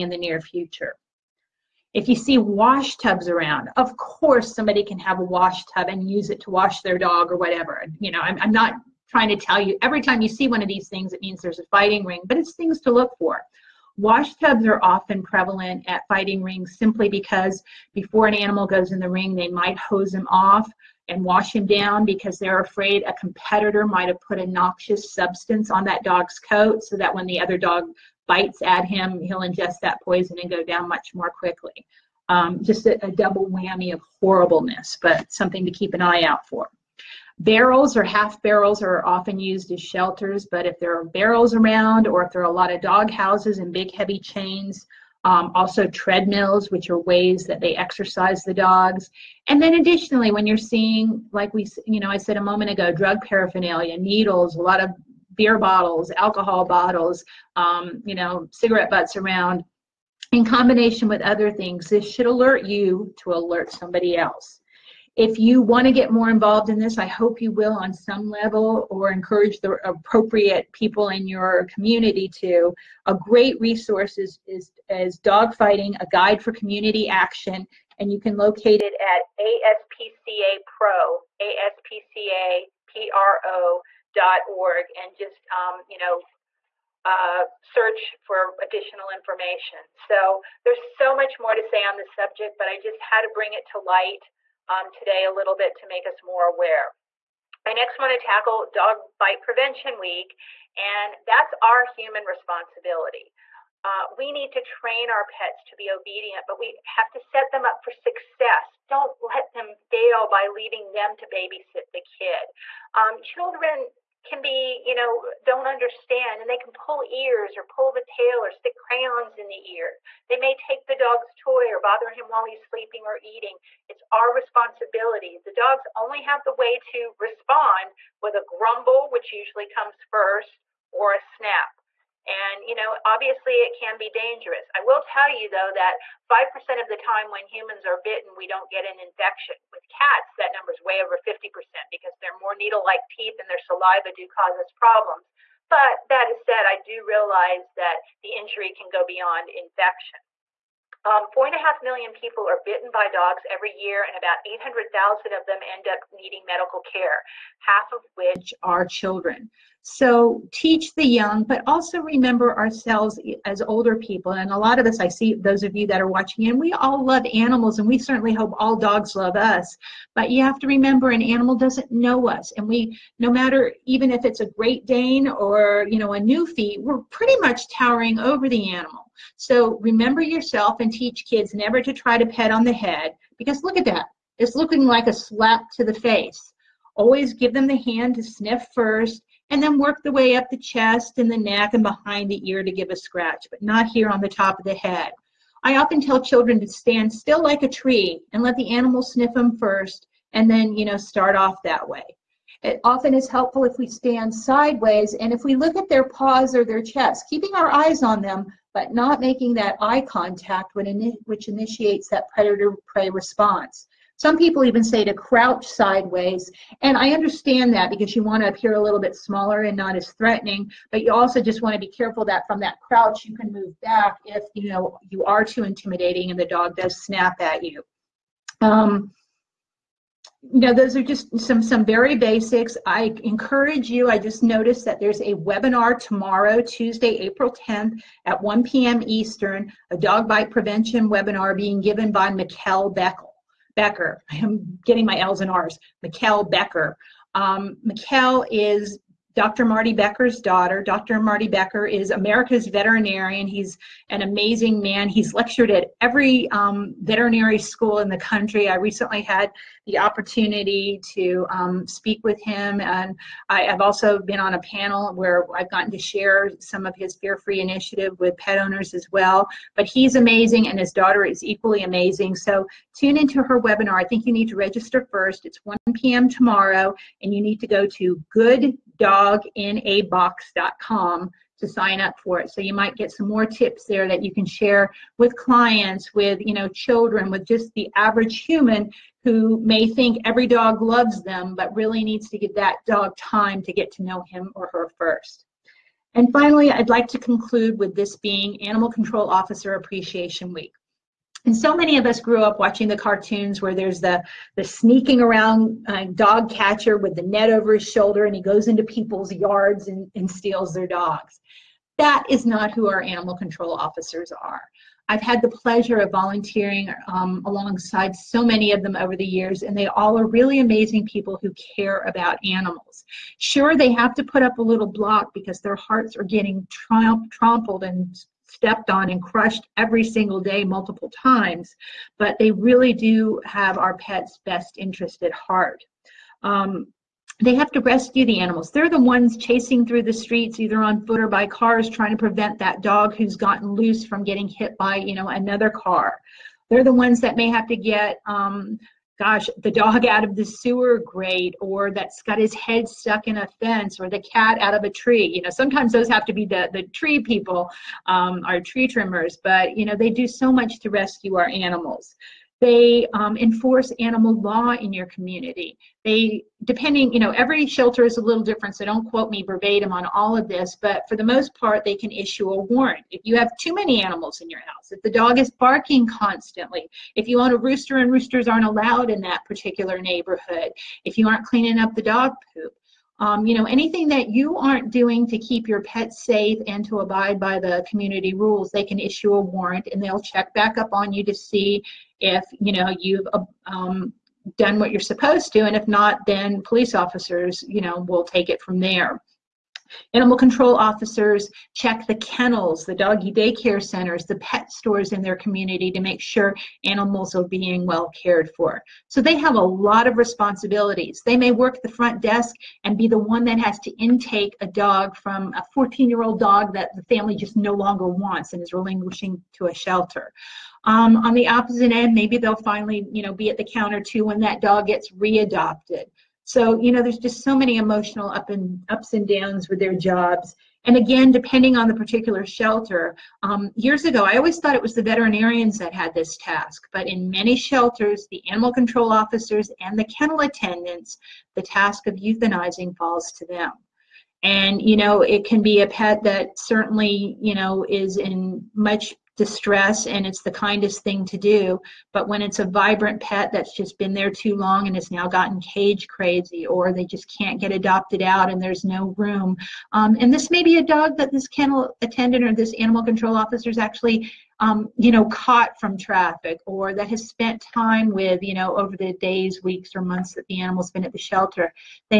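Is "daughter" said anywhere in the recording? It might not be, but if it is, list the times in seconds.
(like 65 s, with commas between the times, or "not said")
250 s, 270 s.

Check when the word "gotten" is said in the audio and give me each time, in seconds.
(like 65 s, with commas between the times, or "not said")
265 s, 343 s, 455 s.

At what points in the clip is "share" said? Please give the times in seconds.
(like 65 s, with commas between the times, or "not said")
265 s, 284 s.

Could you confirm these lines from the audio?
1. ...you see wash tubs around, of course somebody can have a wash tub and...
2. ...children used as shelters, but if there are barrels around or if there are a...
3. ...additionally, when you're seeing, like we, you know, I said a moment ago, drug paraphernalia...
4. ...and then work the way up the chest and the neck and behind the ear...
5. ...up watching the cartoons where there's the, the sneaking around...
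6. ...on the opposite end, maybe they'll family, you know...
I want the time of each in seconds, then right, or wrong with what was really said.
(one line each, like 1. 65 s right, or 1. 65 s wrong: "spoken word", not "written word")
1. 2 s right
2. 39 s wrong: "often", not "children"
3. 49 s right
4. 189 s right
5. 302 s right
6. 421 s wrong: "finally", not "family".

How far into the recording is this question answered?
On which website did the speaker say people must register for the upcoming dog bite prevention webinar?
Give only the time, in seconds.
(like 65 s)
278 s.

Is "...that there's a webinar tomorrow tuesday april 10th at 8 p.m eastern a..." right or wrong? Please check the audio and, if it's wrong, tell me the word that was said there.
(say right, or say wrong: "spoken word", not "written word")
wrong: "1", not "8".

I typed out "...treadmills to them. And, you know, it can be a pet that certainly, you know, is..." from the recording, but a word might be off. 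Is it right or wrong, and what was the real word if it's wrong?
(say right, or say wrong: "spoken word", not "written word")
wrong: "falls", not "treadmills".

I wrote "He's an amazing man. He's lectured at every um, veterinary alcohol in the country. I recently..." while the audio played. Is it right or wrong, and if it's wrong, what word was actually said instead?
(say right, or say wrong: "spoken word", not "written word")
wrong: "school", not "alcohol".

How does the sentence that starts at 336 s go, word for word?
Um, they have to rescue the animals.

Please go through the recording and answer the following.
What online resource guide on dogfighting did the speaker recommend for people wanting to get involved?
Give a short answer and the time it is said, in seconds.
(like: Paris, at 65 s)
Dogfighting, a guide for community action, at 75 s.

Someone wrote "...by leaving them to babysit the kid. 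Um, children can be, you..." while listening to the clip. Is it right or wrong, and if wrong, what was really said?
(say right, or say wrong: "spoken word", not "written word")
right.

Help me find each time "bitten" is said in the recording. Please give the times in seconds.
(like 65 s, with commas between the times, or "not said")
137 s, 152 s.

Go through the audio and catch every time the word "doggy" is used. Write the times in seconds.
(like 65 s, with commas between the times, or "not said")
402 s.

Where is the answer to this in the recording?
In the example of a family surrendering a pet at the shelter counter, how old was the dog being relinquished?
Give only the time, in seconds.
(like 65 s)
415 s.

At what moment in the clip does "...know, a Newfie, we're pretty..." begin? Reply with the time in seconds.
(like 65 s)
175 s.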